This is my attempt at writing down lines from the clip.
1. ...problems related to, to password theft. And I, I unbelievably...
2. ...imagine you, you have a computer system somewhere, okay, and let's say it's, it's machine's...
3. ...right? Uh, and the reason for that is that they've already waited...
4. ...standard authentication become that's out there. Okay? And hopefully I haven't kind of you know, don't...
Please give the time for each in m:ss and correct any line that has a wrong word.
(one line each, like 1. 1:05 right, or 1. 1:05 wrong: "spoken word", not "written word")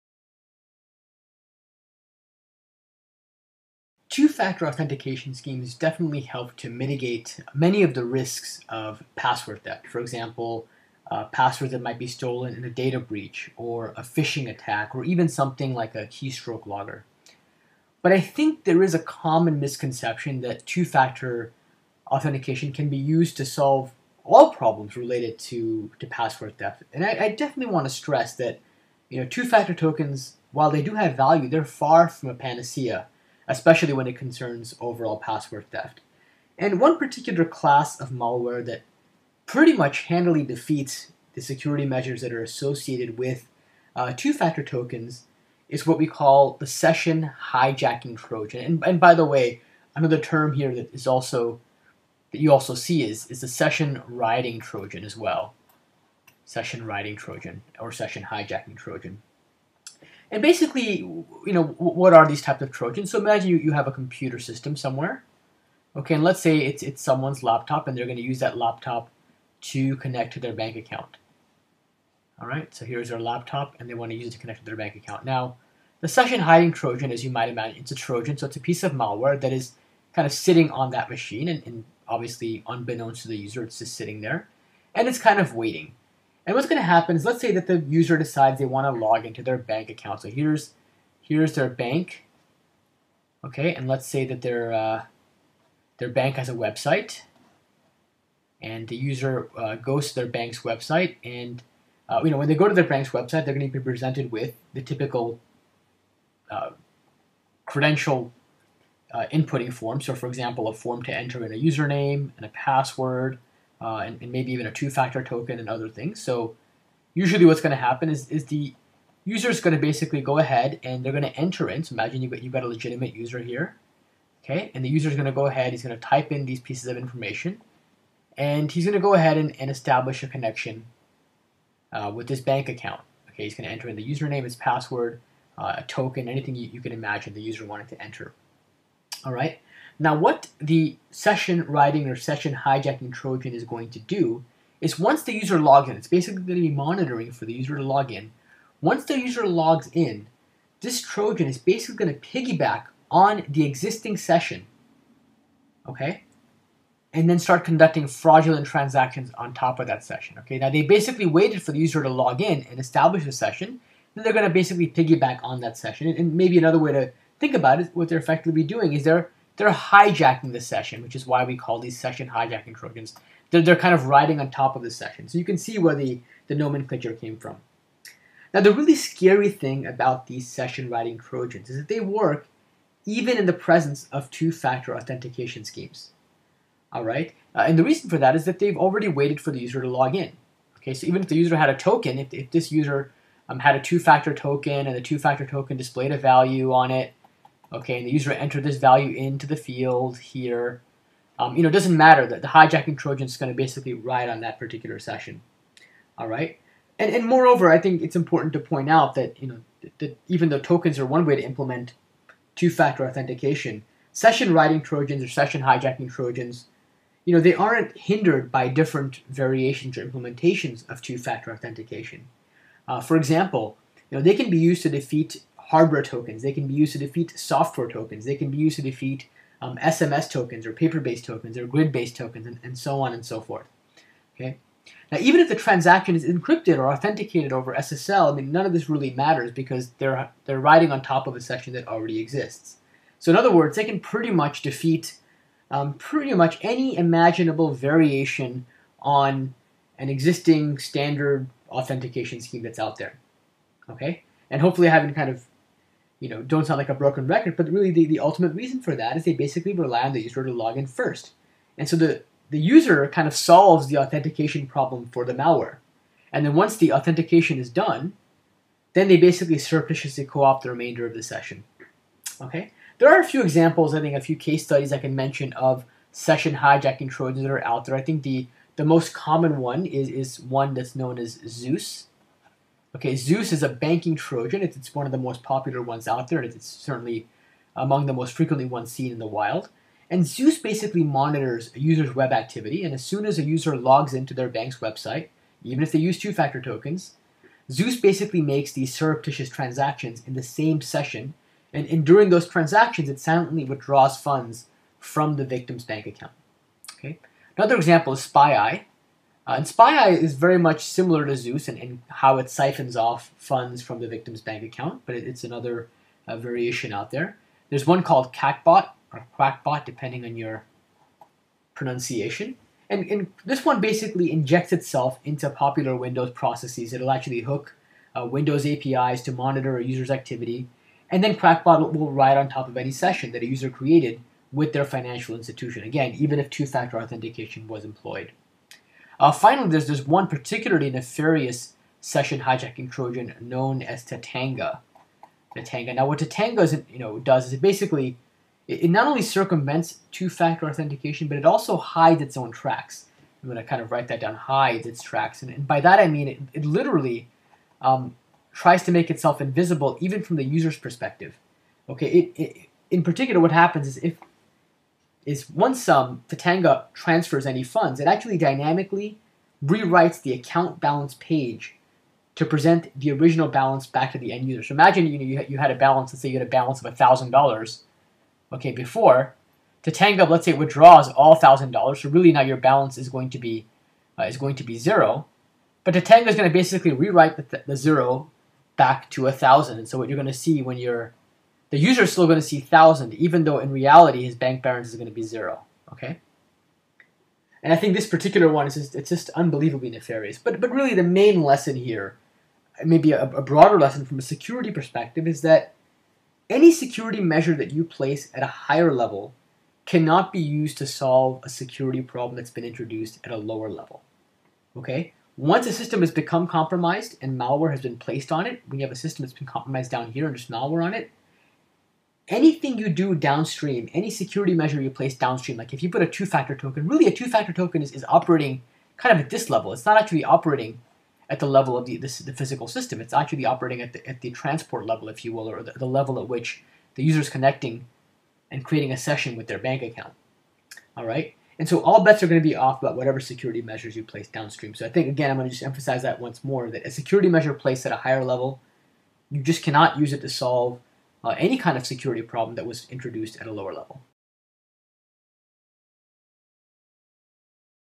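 1. 0:24 wrong: "definitely", not "unbelievably"
2. 1:03 wrong: "someone", not "machine"
3. 3:07 right
4. 4:10 wrong: "scheme", not "become".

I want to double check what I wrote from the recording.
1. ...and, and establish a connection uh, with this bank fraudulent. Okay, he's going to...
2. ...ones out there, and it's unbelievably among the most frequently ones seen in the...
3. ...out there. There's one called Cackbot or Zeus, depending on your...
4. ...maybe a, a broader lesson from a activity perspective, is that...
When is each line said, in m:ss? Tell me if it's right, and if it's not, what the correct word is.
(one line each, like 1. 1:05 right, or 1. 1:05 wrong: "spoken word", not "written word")
1. 2:09 wrong: "account", not "fraudulent"
2. 4:45 wrong: "certainly", not "unbelievably"
3. 5:16 wrong: "Quackbot", not "Zeus"
4. 6:42 wrong: "security", not "activity".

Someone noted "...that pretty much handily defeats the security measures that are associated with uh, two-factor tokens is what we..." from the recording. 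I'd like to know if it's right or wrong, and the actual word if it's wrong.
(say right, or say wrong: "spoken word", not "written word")
right.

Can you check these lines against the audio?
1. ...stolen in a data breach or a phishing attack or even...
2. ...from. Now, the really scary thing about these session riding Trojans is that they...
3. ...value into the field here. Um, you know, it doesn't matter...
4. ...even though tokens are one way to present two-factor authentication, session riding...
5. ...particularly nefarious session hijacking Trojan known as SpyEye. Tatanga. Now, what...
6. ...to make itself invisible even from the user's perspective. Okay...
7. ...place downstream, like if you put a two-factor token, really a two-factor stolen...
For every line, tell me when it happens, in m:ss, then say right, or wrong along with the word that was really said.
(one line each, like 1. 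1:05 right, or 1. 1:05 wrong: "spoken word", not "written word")
1. 0:12 right
2. 2:57 right
3. 3:18 right
4. 3:30 wrong: "implement", not "present"
5. 5:40 wrong: "Tatanga", not "SpyEye"
6. 5:58 right
7. 7:04 wrong: "token", not "stolen".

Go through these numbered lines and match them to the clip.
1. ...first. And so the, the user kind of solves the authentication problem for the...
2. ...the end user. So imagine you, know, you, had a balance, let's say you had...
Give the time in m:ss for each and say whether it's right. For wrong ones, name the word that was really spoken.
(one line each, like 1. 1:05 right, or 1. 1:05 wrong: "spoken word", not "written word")
1. 4:20 right
2. 6:14 right.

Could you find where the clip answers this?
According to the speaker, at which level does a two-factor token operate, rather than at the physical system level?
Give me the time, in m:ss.
7:14.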